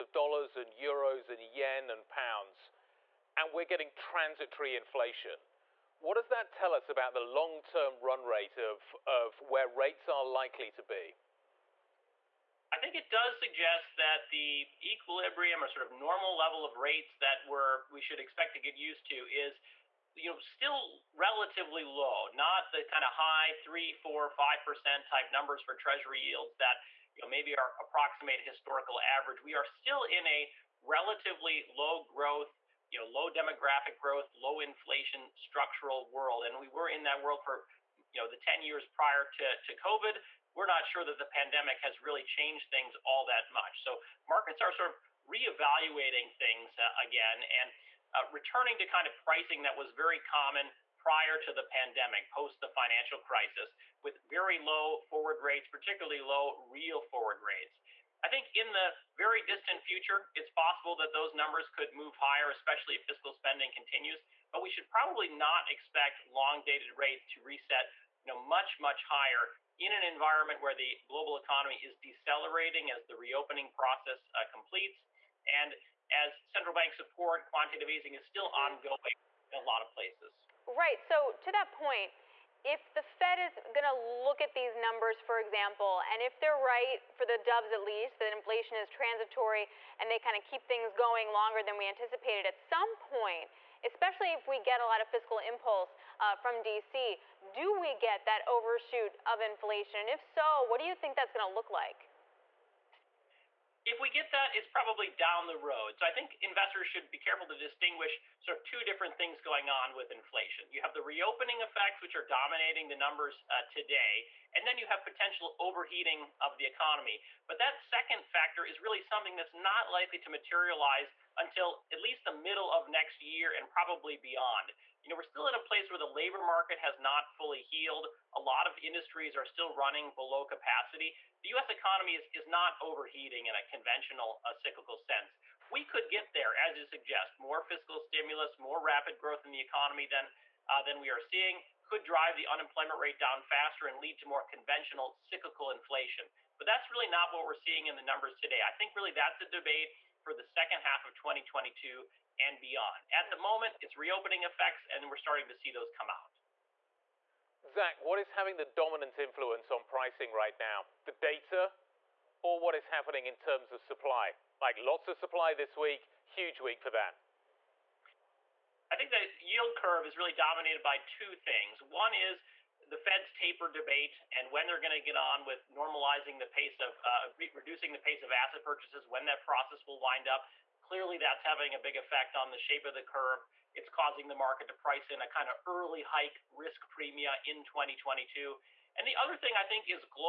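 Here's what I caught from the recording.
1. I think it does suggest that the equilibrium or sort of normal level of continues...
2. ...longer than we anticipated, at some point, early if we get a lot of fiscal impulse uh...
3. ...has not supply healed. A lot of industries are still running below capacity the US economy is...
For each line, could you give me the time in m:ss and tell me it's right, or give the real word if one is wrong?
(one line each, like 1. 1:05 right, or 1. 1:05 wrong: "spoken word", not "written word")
1. 0:12 wrong: "rates", not "continues"
2. 1:31 wrong: "especially", not "early"
3. 2:06 wrong: "fully", not "supply".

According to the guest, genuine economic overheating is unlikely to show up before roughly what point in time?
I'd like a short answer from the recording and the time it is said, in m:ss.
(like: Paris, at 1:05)
middle of next year, at 2:02.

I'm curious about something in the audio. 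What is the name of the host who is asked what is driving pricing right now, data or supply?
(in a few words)
Zach.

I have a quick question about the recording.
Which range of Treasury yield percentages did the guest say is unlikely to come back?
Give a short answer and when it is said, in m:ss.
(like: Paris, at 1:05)
3 4 5 percent, at 0:23.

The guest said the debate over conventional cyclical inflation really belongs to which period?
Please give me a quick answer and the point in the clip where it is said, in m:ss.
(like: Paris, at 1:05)
second half of 2022, at 2:30.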